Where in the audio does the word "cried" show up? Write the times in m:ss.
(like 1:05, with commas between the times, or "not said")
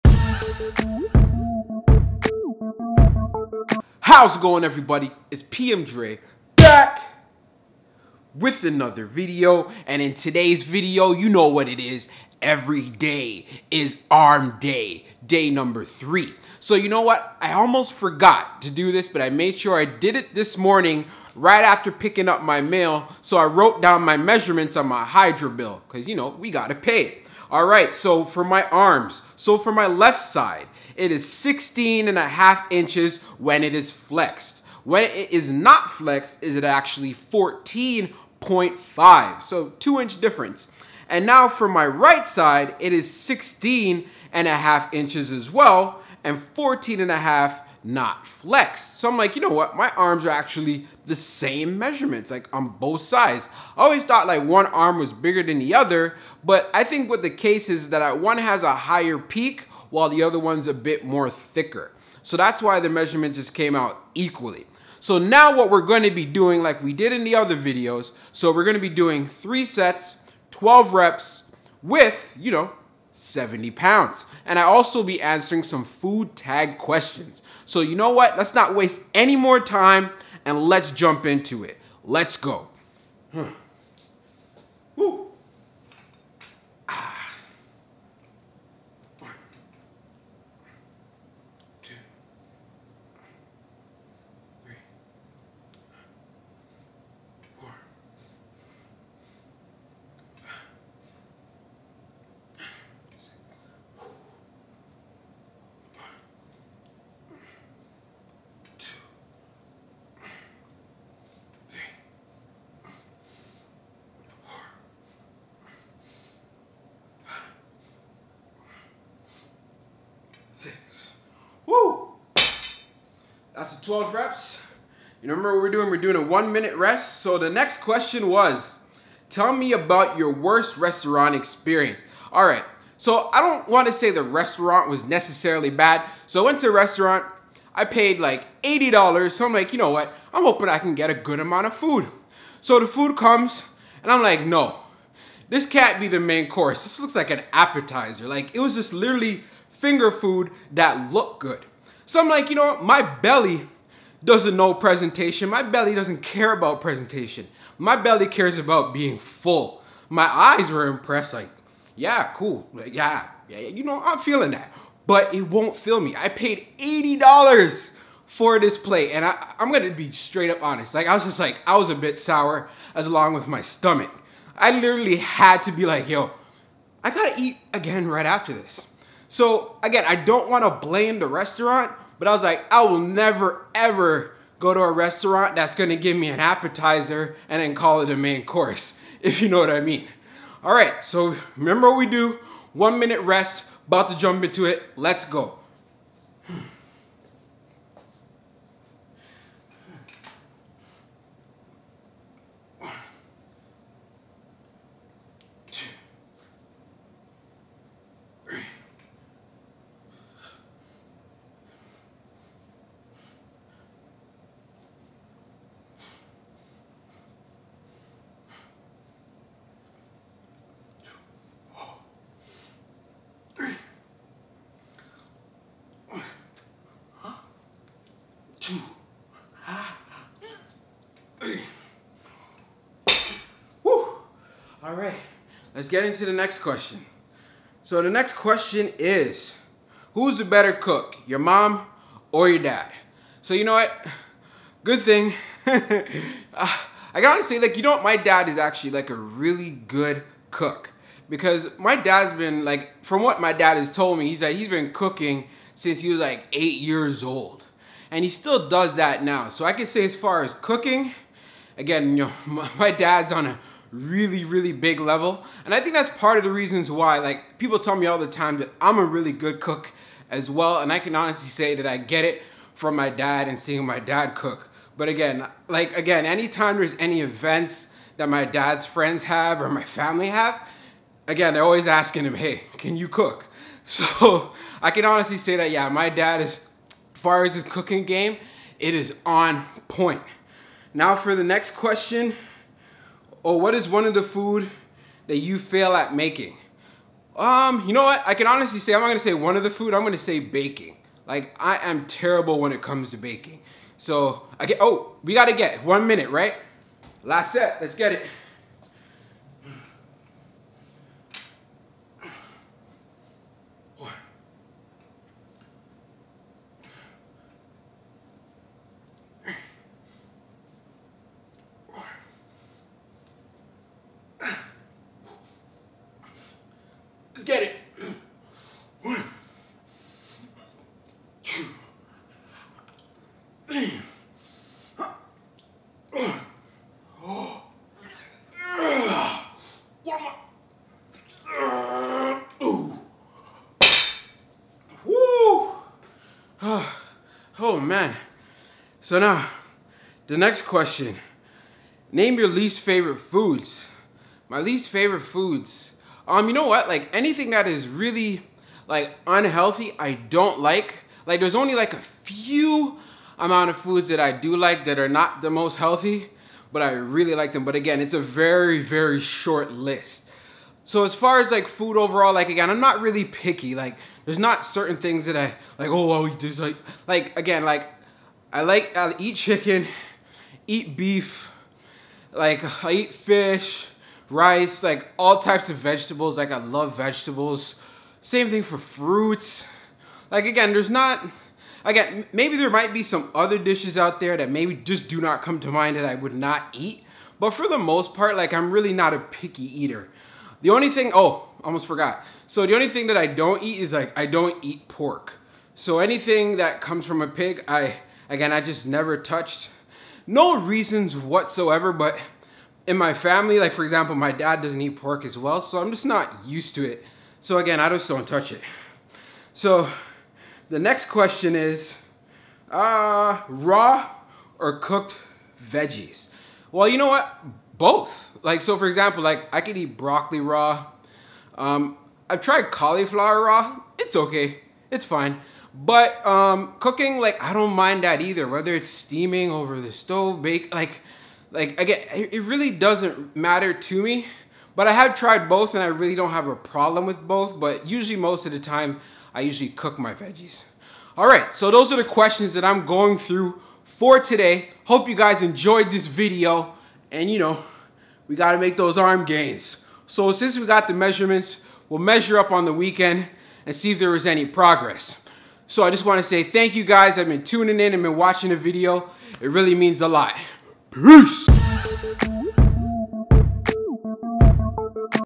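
not said.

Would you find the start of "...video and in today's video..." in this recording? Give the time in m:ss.
0:09.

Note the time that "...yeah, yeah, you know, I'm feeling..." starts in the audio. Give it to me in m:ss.
2:42.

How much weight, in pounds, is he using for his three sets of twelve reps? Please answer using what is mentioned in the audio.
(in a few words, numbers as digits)
70 pounds.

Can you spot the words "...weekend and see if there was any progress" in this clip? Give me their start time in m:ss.
7:42.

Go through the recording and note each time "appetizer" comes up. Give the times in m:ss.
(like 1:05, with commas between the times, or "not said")
2:27, 3:06.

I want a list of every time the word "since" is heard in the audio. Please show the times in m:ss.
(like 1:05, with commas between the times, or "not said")
4:15, 7:40.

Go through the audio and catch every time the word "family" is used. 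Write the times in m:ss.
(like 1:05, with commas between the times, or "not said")
4:39, 6:53.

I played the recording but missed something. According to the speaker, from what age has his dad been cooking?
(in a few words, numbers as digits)
8.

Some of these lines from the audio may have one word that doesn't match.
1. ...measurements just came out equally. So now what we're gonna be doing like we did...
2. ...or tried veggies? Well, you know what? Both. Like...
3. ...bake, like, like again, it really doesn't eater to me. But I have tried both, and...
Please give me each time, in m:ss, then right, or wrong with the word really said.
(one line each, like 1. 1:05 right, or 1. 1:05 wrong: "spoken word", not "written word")
1. 1:02 right
2. 7:04 wrong: "cooked", not "tried"
3. 7:20 wrong: "matter", not "eater".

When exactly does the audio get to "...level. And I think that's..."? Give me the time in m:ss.
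4:24.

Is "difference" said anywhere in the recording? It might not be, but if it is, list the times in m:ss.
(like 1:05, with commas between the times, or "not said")
0:40.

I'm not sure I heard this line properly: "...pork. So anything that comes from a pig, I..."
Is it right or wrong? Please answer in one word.
right.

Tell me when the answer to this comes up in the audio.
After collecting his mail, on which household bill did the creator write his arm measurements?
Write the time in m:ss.
0:25.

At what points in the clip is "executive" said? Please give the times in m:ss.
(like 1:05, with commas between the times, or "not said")
not said.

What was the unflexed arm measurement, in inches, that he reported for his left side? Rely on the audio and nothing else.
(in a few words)
14.5.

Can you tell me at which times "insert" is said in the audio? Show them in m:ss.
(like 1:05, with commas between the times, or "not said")
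not said.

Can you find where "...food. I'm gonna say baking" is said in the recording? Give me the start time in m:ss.
4:59.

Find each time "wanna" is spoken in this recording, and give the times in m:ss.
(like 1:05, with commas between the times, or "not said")
3:00, 7:46.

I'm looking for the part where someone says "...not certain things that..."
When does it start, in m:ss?
6:14.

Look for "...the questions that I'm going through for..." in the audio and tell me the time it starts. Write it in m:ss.
7:31.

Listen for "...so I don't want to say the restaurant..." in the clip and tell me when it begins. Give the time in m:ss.
2:12.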